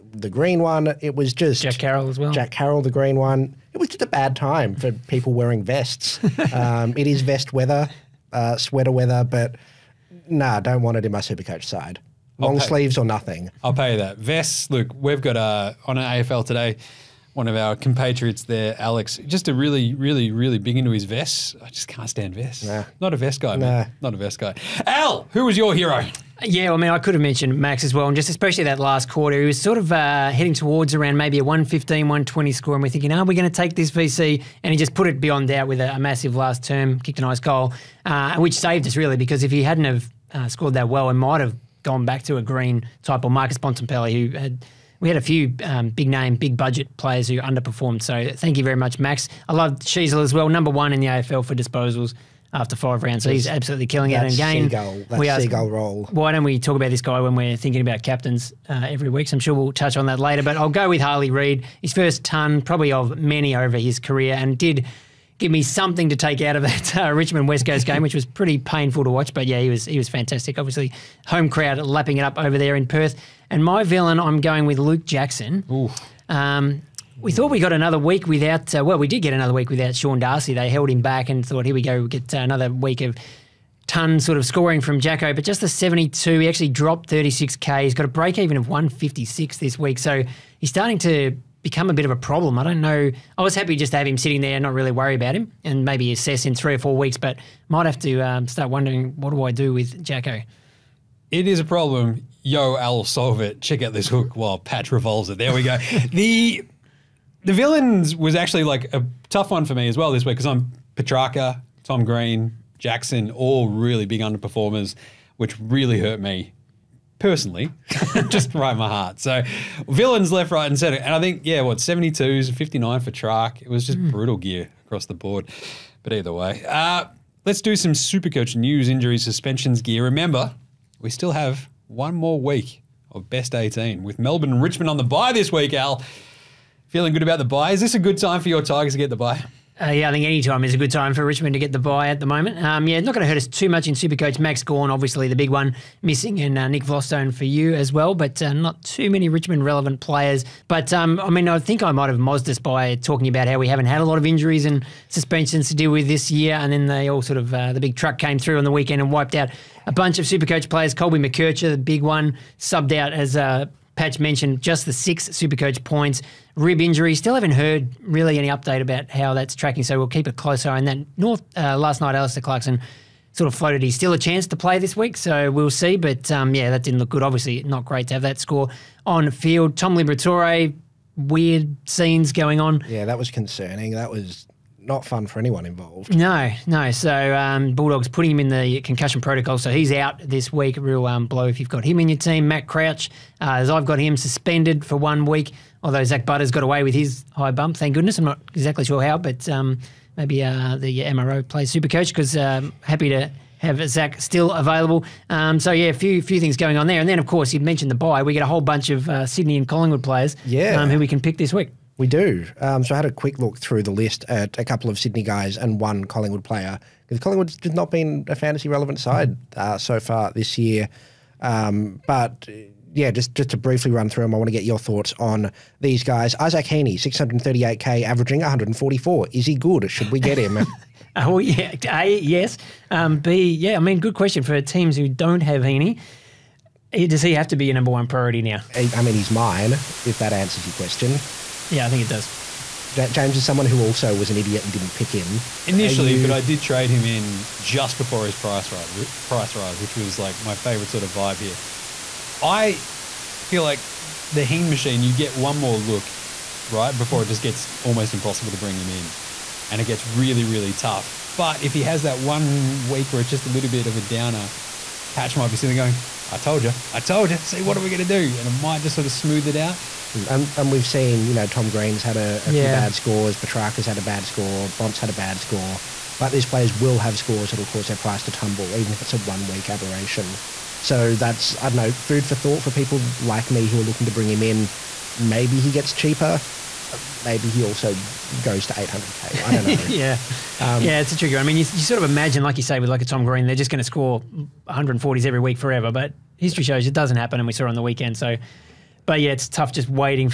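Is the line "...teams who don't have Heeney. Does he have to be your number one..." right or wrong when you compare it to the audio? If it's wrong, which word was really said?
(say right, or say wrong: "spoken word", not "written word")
right.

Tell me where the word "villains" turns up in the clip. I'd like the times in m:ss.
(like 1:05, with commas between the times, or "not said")
1:13, 1:47, 1:59.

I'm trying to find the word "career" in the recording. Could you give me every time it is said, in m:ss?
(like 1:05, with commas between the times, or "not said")
1:03.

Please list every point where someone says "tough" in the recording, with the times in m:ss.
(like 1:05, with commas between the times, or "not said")
1:49, 4:20, 4:59.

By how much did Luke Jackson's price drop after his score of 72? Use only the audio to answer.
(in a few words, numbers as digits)
36k.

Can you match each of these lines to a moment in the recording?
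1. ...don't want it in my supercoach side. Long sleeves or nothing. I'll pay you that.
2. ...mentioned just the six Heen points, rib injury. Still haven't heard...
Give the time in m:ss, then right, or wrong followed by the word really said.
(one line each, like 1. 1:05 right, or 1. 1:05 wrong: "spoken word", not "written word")
1. 0:10 right
2. 2:44 wrong: "Supercoach", not "Heen".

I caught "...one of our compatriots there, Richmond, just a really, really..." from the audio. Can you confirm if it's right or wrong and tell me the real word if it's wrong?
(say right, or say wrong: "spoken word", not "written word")
wrong: "Alex", not "Richmond".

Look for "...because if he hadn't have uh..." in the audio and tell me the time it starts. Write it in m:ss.
0:39.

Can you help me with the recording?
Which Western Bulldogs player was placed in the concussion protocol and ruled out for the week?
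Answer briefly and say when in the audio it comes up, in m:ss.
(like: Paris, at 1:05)
Tom Liberatore, at 2:59.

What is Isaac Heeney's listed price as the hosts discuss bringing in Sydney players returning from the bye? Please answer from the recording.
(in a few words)
638k.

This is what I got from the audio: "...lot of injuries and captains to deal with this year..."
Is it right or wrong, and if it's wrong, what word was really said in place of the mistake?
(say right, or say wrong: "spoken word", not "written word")
wrong: "suspensions", not "captains".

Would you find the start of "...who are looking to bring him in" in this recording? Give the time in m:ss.
4:43.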